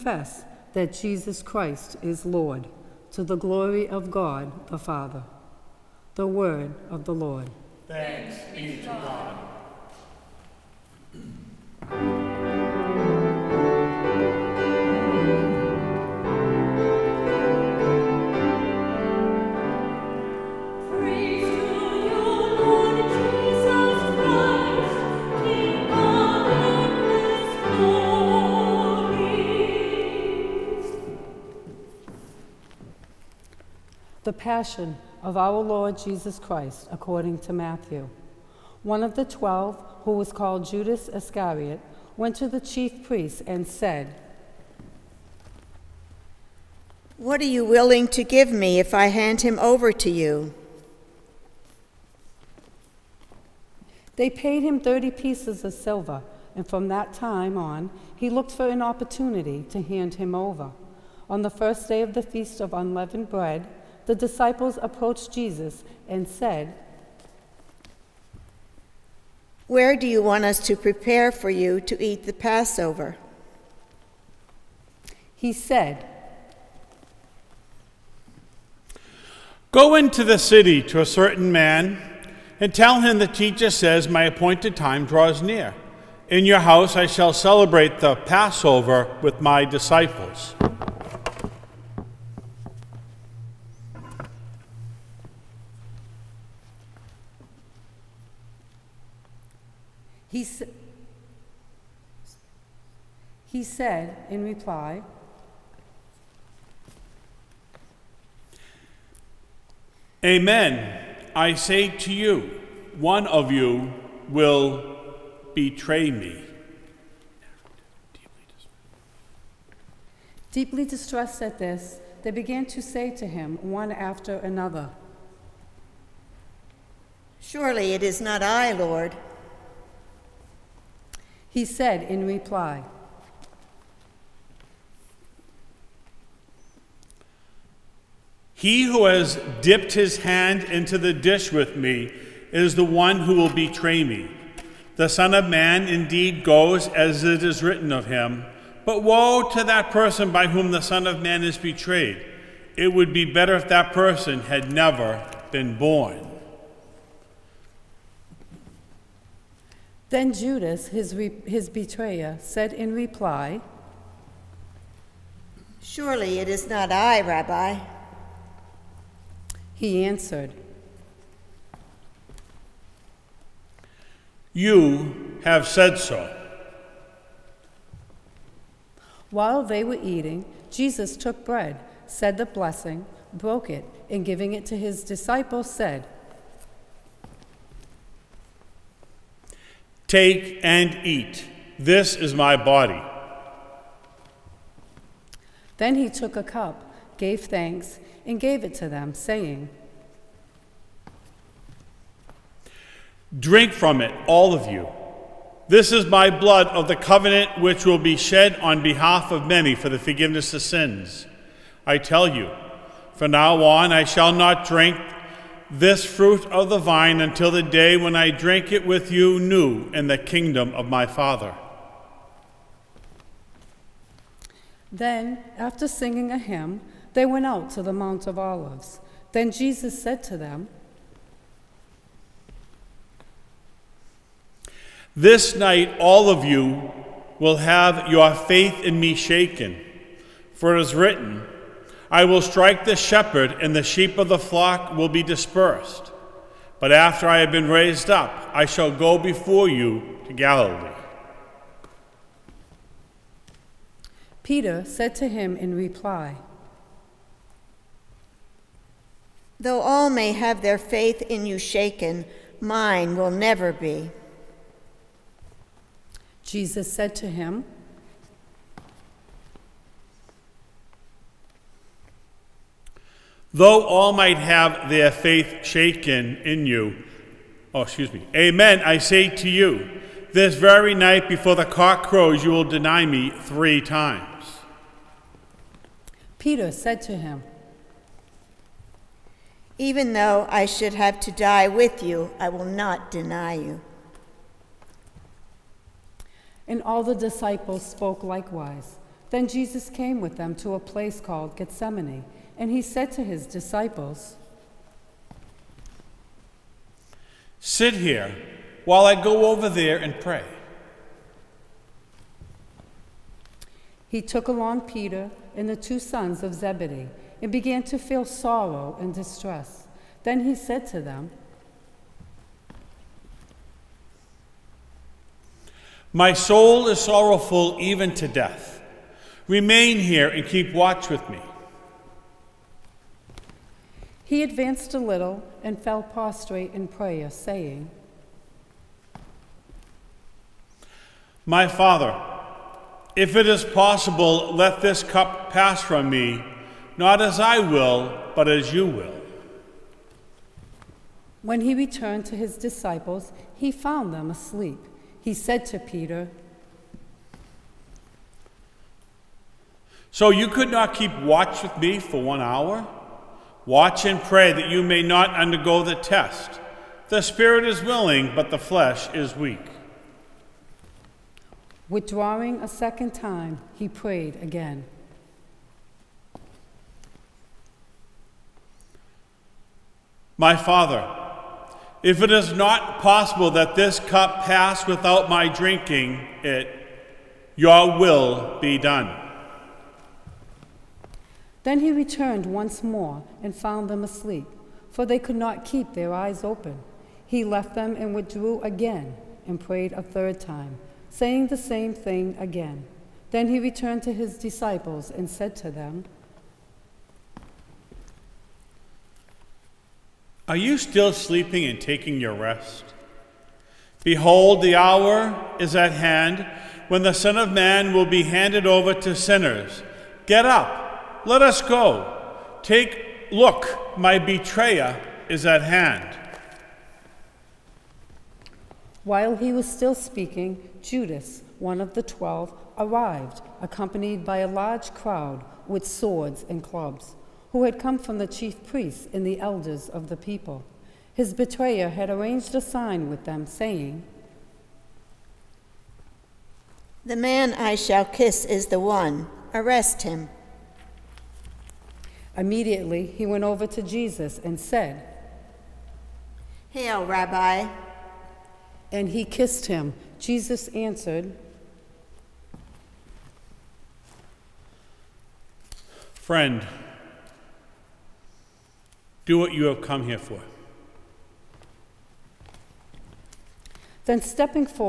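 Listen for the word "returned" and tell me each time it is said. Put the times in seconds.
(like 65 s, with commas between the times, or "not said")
351 s, 391 s, 403 s.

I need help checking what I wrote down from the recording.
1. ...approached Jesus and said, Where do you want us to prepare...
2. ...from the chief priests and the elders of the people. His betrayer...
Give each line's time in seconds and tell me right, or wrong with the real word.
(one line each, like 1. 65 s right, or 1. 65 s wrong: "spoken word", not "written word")
1. 64 s right
2. 437 s right.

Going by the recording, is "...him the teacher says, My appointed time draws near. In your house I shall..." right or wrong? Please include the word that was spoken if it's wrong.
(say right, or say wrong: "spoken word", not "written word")
right.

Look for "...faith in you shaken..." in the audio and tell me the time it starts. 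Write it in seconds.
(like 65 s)
260 s.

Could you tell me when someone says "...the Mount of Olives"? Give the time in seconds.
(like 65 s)
227 s.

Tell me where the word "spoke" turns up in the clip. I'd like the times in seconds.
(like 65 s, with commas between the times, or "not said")
297 s.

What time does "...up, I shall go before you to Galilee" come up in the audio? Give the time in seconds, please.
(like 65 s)
248 s.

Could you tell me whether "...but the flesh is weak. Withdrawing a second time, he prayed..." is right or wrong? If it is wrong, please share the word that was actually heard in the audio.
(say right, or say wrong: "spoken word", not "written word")
right.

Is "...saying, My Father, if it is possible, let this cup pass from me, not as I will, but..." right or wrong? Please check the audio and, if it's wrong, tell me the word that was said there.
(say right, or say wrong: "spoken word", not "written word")
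right.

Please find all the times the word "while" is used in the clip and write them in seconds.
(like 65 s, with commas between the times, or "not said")
179 s, 308 s, 429 s.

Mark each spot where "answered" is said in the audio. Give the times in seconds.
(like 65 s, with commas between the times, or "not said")
170 s, 460 s.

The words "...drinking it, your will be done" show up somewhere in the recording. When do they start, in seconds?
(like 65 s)
385 s.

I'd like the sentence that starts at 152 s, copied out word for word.
It would be better if that person had never been born.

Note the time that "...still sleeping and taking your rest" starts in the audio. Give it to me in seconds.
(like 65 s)
410 s.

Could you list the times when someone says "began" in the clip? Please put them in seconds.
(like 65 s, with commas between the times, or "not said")
122 s, 317 s.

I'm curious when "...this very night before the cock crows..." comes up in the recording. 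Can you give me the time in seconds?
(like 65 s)
280 s.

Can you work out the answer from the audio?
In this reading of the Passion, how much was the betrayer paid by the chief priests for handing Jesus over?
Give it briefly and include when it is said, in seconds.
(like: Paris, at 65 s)
30 pieces of silver, at 54 s.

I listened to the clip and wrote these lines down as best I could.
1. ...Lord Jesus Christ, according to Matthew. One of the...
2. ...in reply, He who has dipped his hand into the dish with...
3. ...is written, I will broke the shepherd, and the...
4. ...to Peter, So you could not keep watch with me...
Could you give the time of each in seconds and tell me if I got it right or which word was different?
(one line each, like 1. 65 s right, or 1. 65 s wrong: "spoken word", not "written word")
1. 35 s right
2. 132 s right
3. 240 s wrong: "strike", not "broke"
4. 355 s right.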